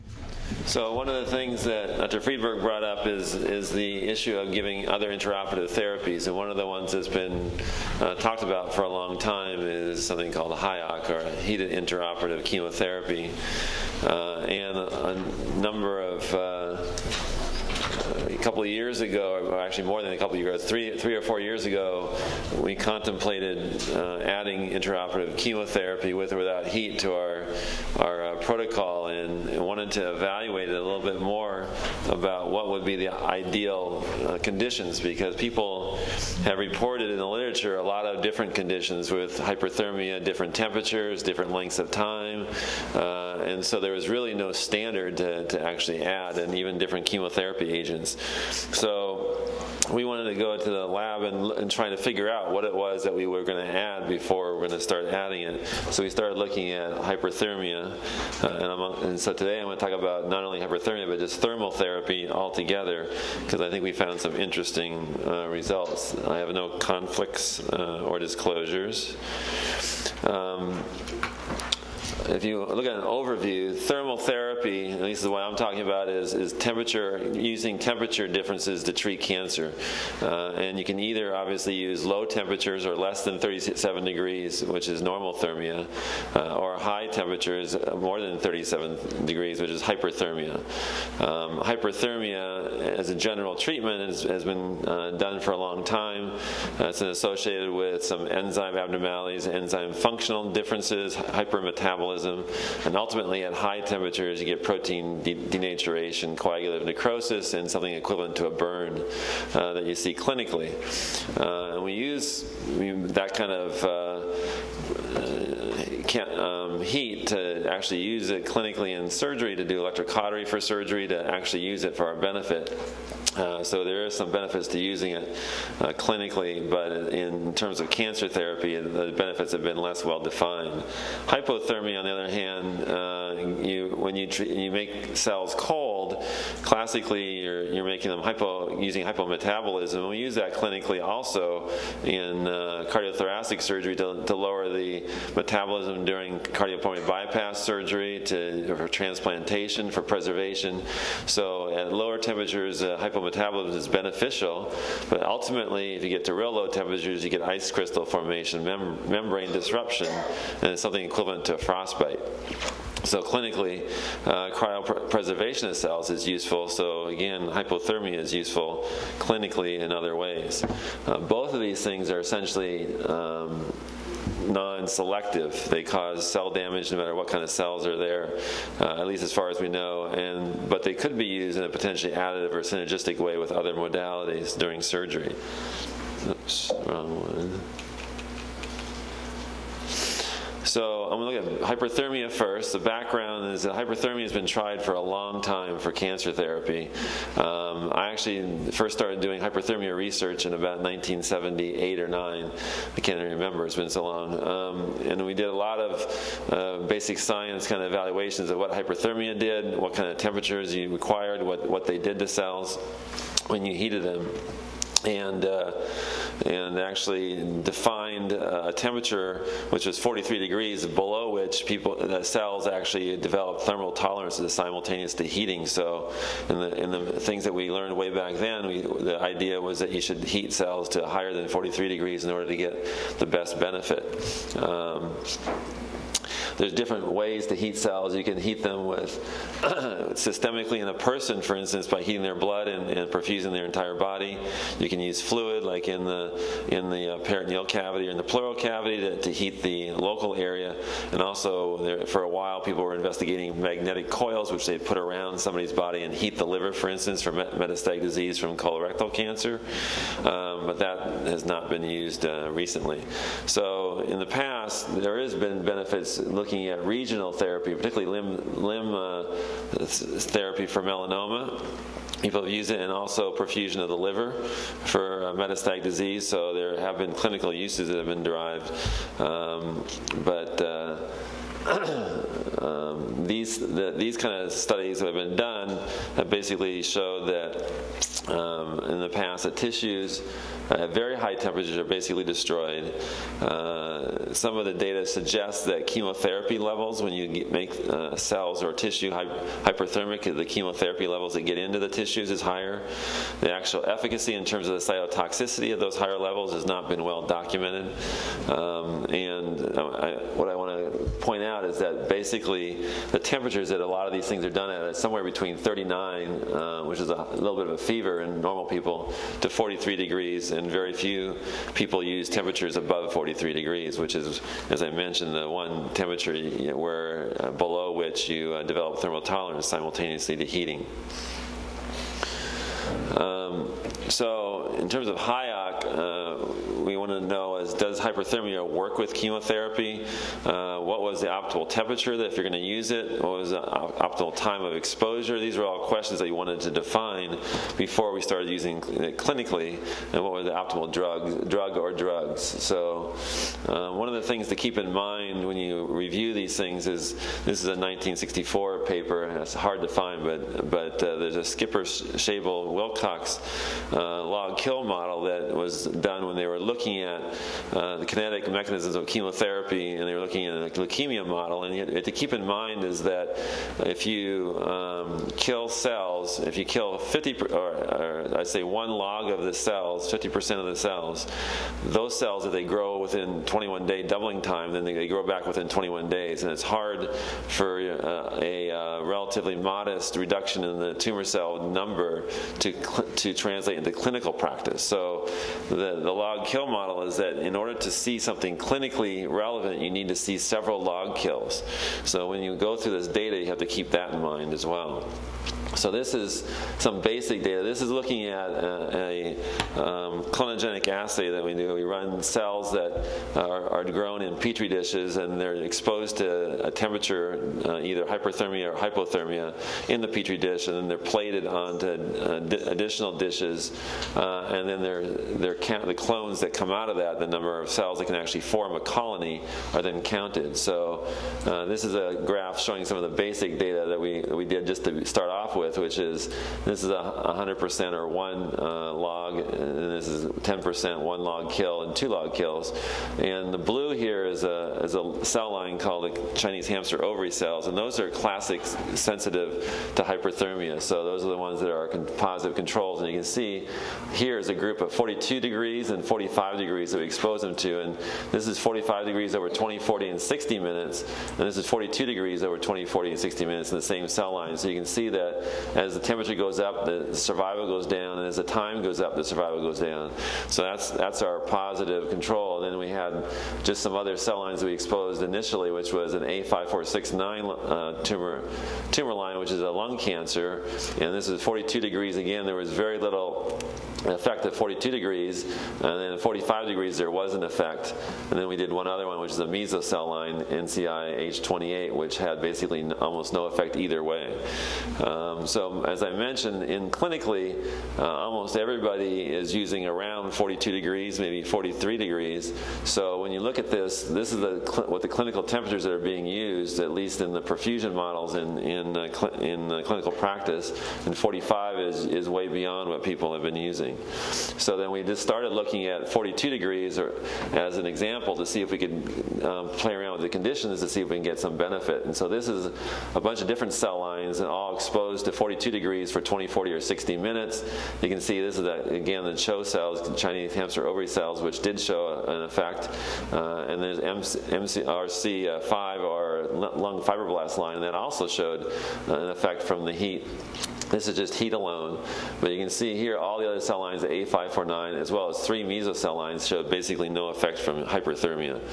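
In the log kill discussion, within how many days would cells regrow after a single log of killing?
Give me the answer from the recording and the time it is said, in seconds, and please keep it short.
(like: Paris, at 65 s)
21 days, at 385 s.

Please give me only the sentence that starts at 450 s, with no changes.
So those are the ones that are con positive controls.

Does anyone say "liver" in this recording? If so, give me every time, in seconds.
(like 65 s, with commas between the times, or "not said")
256 s, 273 s.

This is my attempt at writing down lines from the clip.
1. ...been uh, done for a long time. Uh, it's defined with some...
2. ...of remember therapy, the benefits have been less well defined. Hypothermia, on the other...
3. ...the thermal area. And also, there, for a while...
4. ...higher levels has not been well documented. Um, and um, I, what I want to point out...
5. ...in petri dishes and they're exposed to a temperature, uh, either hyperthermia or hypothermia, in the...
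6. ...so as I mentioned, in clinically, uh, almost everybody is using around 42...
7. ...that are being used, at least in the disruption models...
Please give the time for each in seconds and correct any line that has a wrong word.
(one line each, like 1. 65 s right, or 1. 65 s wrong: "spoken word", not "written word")
1. 94 s wrong: "associated", not "defined"
2. 127 s wrong: "cancer", not "remember"
3. 249 s wrong: "local", not "thermal"
4. 305 s right
5. 414 s right
6. 495 s right
7. 505 s wrong: "perfusion", not "disruption".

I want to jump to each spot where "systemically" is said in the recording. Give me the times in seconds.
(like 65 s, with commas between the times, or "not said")
240 s.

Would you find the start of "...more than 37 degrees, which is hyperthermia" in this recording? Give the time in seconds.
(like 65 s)
88 s.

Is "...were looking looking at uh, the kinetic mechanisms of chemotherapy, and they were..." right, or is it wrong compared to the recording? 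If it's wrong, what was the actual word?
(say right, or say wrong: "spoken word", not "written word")
right.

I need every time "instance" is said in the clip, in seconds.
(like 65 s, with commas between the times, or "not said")
241 s, 256 s.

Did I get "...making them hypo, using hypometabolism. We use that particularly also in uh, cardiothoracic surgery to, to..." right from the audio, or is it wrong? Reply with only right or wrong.
wrong.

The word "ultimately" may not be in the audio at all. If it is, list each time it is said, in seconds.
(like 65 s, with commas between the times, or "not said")
102 s, 155 s.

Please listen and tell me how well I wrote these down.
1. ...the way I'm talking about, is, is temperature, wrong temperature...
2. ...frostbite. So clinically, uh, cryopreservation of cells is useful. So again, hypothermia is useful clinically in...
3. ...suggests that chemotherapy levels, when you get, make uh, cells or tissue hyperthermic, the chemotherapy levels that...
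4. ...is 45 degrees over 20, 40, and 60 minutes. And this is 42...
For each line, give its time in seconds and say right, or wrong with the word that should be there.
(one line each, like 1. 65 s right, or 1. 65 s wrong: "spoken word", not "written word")
1. 75 s wrong: "using", not "wrong"
2. 161 s right
3. 295 s right
4. 458 s right.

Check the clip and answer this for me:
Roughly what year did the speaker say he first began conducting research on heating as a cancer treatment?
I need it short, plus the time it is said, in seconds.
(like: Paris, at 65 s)
1978, at 200 s.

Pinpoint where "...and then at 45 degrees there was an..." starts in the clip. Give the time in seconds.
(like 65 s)
485 s.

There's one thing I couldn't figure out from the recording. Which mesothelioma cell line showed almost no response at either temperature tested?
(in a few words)
NCI H28.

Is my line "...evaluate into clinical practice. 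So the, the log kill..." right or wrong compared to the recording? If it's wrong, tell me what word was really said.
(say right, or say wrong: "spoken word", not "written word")
wrong: "translate", not "evaluate".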